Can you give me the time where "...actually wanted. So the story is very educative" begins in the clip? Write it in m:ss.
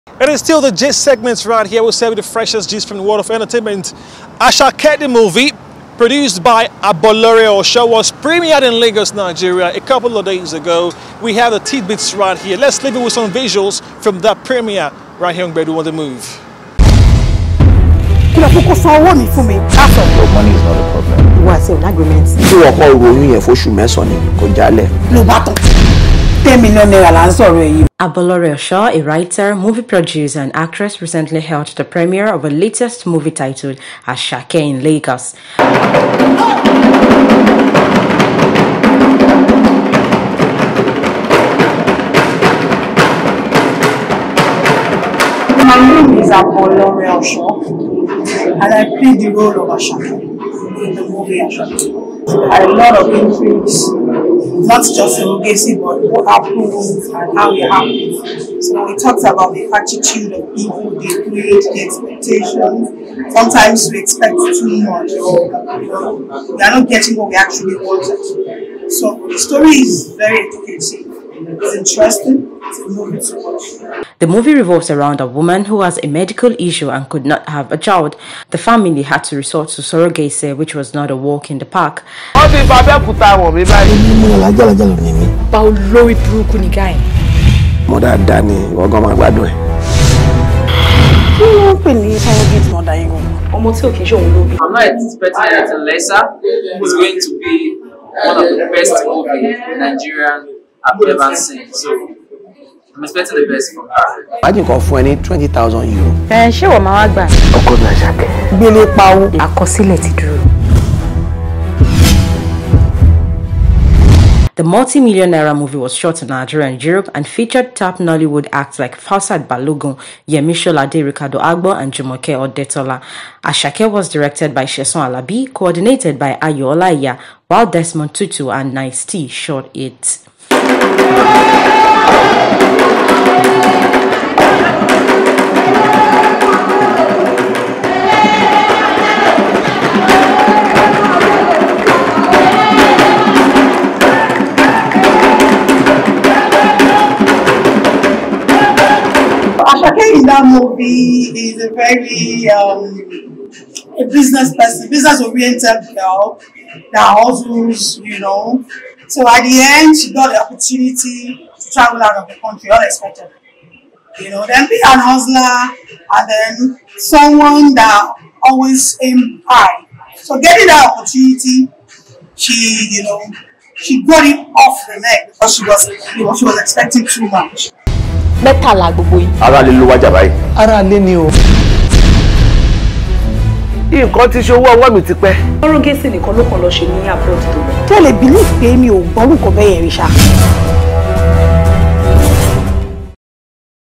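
1:07.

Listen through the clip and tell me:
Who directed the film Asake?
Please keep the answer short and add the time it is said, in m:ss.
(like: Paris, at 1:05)
Sheson Alabi, at 2:04.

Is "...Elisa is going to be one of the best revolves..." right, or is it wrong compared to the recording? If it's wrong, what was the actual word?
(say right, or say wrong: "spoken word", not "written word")
wrong: "movies", not "revolves".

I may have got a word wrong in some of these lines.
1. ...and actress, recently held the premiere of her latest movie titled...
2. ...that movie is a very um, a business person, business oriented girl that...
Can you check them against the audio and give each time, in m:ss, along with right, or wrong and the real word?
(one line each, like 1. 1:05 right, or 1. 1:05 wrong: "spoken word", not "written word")
1. 0:30 right
2. 2:30 right.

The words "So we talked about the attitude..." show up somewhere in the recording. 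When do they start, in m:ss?
0:58.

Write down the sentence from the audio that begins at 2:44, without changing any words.
You know, then be an hustler and then someone that always aim high.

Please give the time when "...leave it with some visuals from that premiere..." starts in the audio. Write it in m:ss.
0:12.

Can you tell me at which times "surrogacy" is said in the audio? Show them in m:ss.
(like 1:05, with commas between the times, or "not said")
0:55, 1:19.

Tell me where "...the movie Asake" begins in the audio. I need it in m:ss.
0:50.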